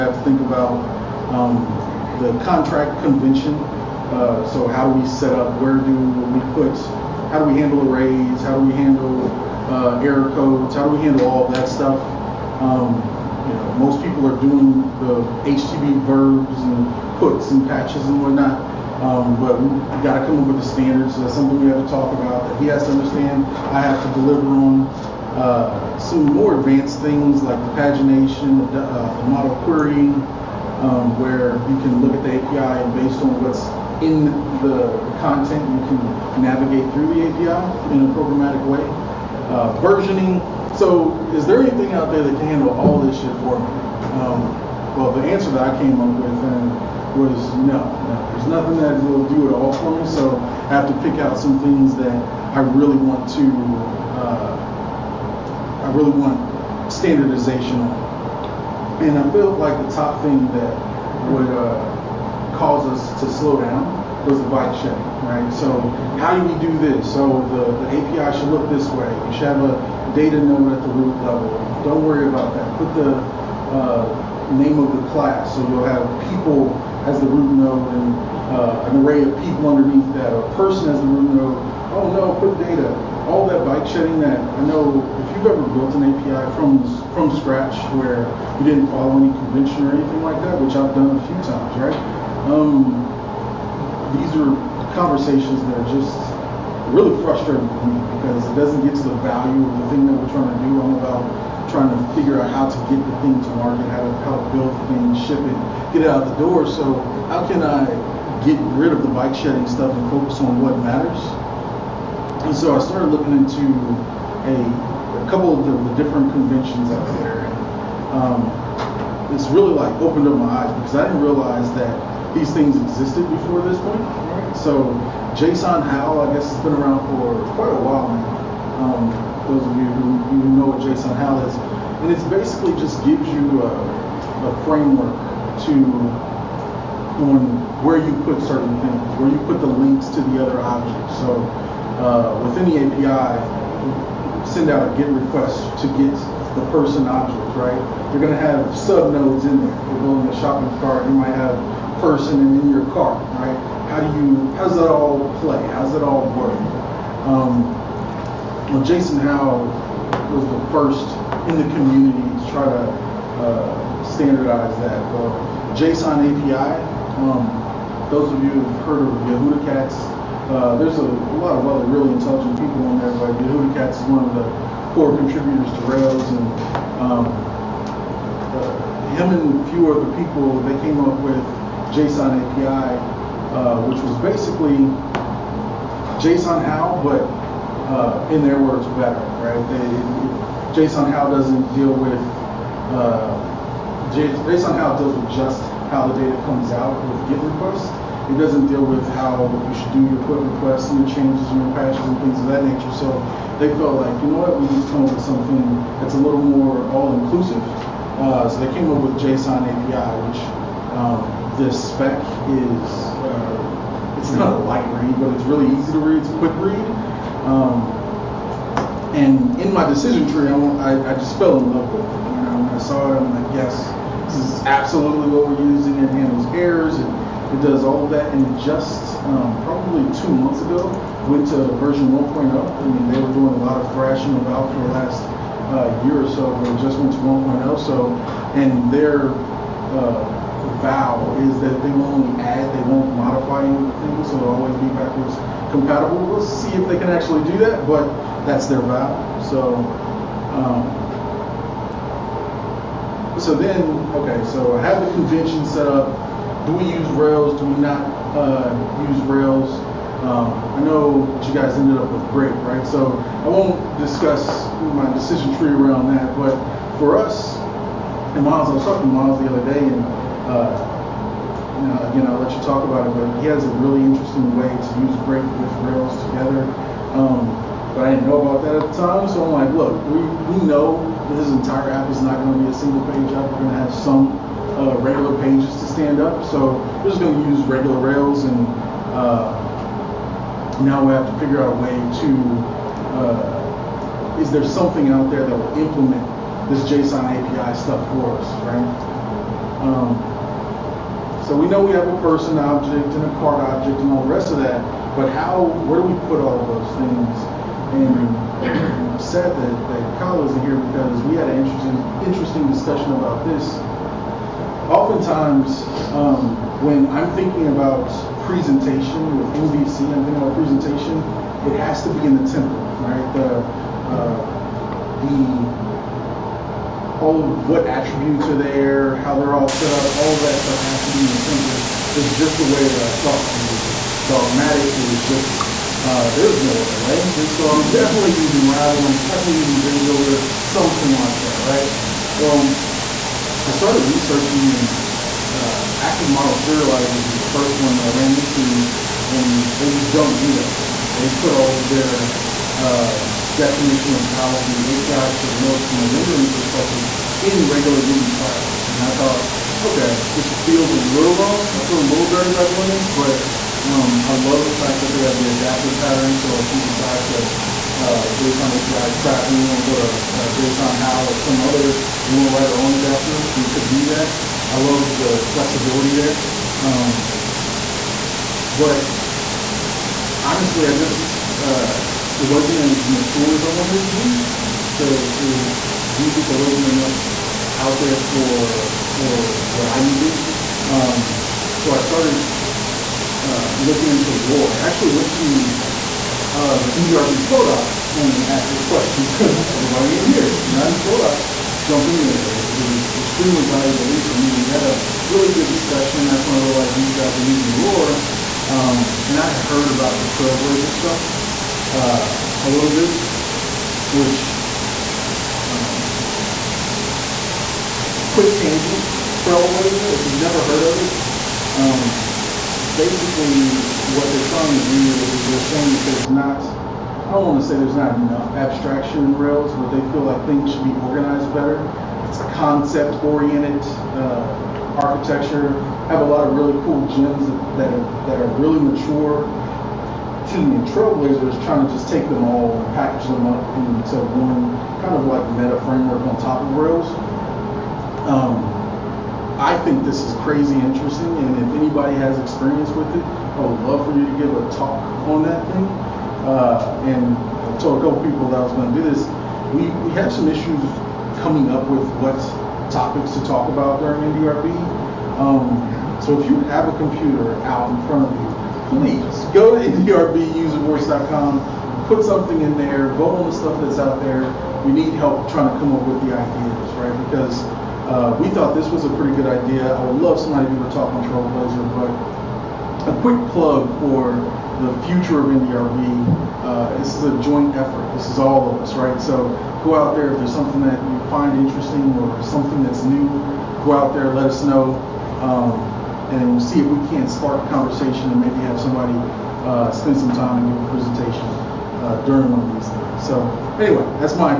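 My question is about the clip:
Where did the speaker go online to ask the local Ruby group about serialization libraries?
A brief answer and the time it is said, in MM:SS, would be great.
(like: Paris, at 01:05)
Indy.rb Flowdock, at 06:36.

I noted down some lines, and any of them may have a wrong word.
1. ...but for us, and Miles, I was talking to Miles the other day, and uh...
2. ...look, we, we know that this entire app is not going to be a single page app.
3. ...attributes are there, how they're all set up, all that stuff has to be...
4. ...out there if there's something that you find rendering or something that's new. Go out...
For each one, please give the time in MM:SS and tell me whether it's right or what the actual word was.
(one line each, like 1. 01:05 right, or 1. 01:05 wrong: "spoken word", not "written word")
1. 04:26 right
2. 04:39 right
3. 05:27 right
4. 08:09 wrong: "interesting", not "rendering".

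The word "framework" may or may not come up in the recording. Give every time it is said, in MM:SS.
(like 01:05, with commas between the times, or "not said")
02:14, 07:25.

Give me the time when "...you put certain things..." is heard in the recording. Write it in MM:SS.
02:17.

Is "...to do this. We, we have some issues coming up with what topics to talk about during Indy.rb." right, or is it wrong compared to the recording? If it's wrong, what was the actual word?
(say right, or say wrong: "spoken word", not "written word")
right.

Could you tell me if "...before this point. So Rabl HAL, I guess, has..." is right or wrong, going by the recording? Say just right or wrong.
wrong.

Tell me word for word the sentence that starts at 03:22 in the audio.
So they felt like, you know what, we need to come up with something that's a little more all-inclusive.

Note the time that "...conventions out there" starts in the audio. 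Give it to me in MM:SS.
01:56.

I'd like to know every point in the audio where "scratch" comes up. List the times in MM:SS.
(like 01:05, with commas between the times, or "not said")
01:27.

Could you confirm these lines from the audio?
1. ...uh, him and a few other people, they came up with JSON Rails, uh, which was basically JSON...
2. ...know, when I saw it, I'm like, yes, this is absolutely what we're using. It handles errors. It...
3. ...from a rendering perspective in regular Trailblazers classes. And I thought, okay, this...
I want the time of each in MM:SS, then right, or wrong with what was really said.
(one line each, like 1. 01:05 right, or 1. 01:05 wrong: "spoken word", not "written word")
1. 02:58 wrong: "API", not "Rails"
2. 03:42 right
3. 05:55 wrong: "Ruby", not "Trailblazers".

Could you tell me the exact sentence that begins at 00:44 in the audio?
Um, well, the answer that I came up with um, was no, no.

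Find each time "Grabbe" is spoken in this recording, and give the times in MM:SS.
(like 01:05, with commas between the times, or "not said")
not said.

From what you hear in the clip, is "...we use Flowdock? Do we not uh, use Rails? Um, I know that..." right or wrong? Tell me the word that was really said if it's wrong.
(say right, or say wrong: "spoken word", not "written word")
wrong: "Rails", not "Flowdock".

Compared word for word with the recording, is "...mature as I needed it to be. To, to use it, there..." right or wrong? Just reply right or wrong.
wrong.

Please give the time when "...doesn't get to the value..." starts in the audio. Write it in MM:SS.
01:38.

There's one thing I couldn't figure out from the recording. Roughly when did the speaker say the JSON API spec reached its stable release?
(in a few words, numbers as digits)
two months ago.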